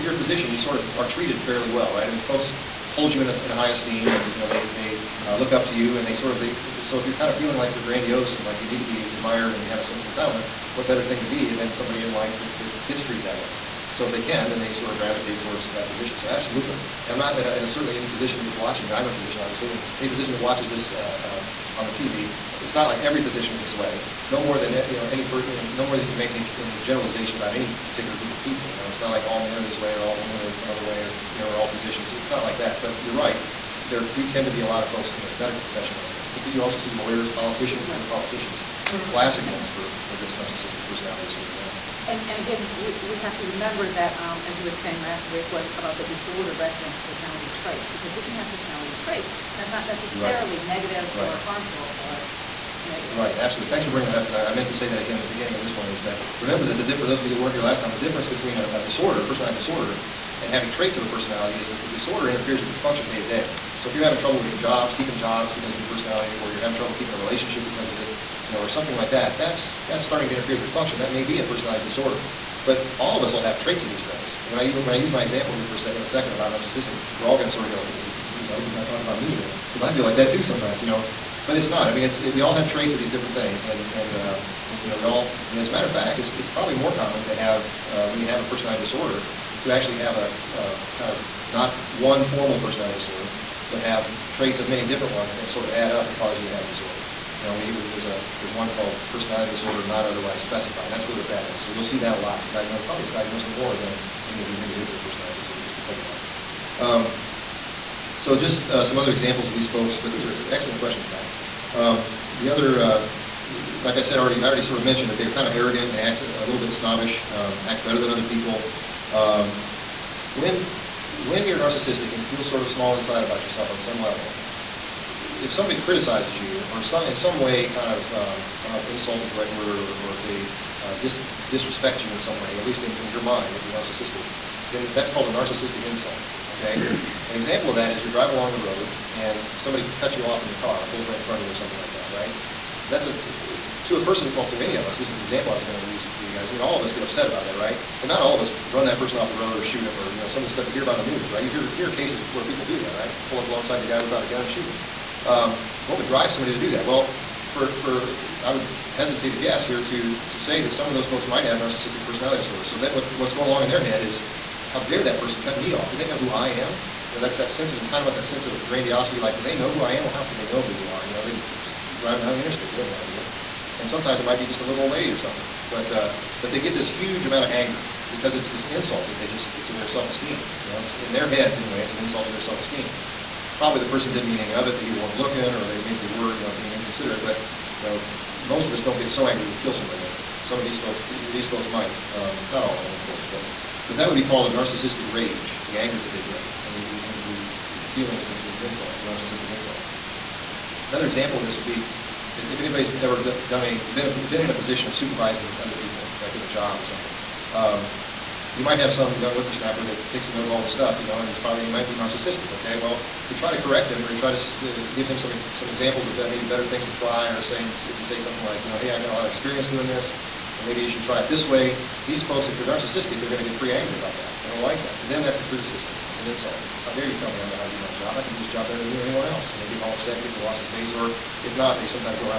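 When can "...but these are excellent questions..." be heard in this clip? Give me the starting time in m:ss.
1:49.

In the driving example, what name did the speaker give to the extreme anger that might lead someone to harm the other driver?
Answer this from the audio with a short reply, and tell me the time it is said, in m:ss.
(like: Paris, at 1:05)
narcissistic rage, at 3:14.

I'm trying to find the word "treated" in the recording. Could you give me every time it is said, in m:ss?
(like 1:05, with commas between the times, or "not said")
0:01, 0:13.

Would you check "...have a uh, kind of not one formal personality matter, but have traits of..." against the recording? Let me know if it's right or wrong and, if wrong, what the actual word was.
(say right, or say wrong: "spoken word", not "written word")
wrong: "disorder", not "matter".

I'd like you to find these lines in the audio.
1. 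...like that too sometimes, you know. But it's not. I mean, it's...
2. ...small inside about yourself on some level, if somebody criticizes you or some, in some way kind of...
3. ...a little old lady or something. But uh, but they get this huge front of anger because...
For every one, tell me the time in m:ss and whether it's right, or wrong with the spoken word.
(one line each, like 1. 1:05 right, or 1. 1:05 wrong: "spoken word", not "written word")
1. 1:20 right
2. 2:02 right
3. 2:54 wrong: "amount", not "front".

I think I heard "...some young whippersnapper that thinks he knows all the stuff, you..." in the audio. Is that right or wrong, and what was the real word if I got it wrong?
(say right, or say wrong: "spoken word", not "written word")
right.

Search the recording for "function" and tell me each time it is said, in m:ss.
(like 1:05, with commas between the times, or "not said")
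1:02, 1:10.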